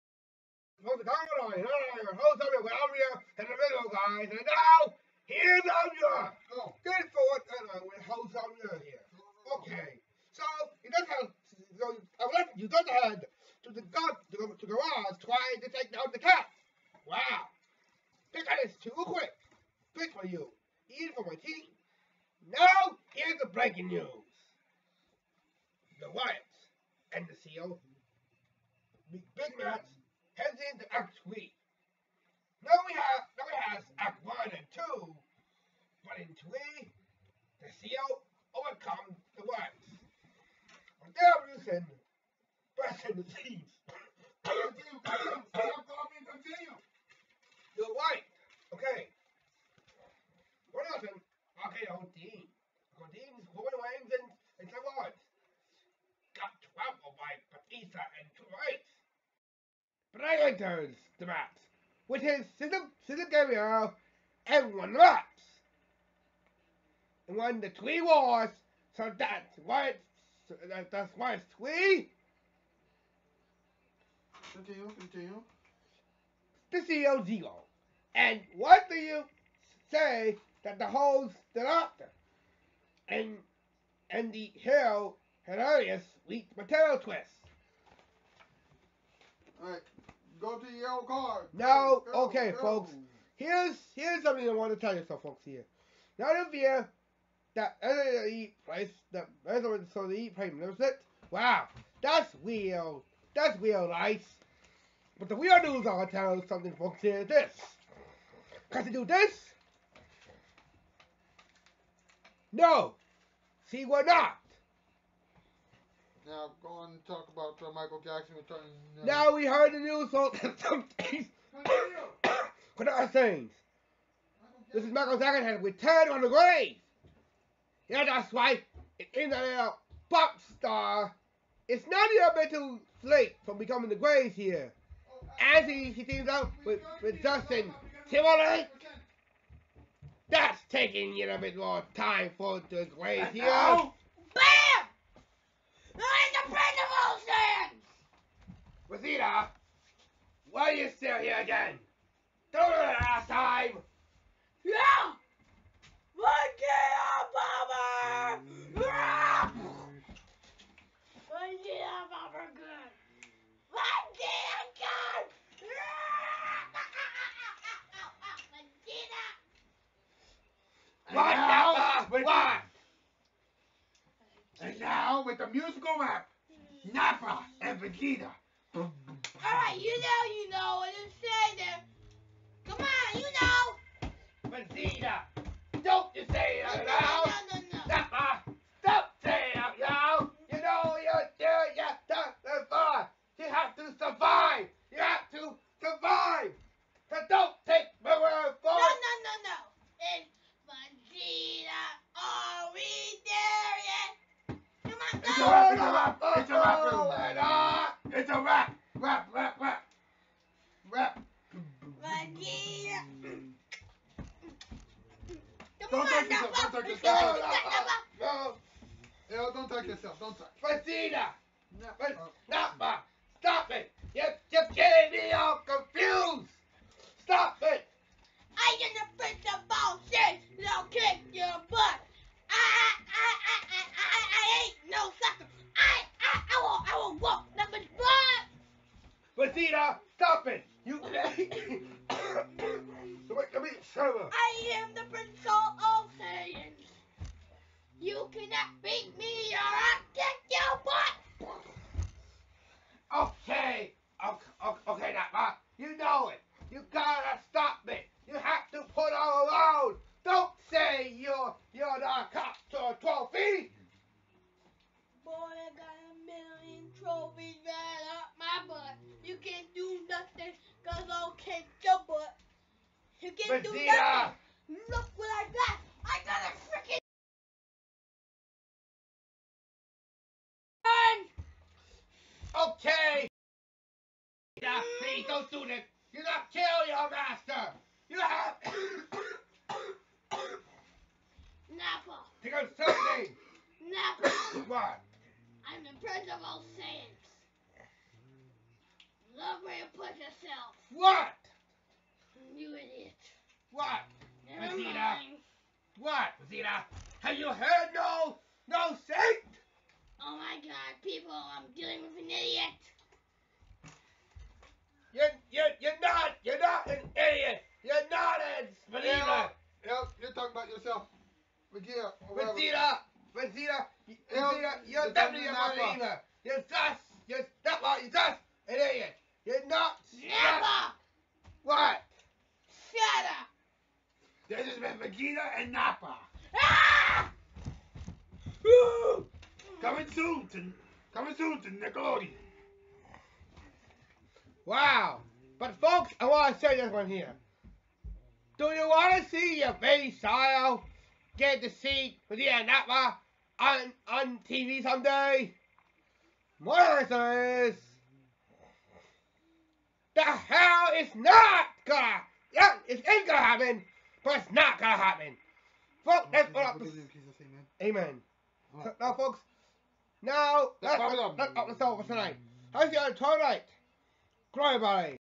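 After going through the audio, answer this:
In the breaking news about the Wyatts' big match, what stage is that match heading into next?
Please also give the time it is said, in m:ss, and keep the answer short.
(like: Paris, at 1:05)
Act 3, at 0:30.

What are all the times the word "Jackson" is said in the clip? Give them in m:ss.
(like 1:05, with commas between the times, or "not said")
1:58, 2:05.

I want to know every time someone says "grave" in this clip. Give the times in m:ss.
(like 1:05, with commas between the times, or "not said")
2:06, 2:13, 2:22.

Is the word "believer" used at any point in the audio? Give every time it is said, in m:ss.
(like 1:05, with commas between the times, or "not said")
5:18, 5:25.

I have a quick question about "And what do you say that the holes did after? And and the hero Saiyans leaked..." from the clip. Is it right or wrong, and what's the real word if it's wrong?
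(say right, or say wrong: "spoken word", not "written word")
wrong: "Herodias", not "Saiyans".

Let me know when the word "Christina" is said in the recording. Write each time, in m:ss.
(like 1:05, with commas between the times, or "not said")
3:40, 3:59.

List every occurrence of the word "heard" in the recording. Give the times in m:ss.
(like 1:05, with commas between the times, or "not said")
1:59, 5:07.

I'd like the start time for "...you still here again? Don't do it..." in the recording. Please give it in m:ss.
2:30.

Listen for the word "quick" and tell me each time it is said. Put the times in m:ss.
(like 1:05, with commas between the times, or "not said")
0:18.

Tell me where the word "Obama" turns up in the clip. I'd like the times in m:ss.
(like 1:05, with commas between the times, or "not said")
2:37, 2:41.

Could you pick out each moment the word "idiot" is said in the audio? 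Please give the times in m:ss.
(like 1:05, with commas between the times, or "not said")
5:02, 5:12, 5:17.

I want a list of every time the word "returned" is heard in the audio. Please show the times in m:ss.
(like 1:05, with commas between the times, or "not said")
2:05.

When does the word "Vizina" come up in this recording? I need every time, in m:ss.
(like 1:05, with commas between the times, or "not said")
5:06.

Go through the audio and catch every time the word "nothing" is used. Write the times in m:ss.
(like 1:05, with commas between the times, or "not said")
3:57, 4:33.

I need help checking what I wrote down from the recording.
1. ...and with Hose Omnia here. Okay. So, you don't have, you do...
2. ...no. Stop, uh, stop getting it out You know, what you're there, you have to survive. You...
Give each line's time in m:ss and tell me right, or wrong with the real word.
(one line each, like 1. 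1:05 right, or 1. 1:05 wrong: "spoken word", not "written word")
1. 0:07 right
2. 3:07 wrong: "saying", not "getting".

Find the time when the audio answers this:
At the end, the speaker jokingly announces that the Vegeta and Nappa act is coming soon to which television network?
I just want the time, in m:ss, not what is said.
5:41.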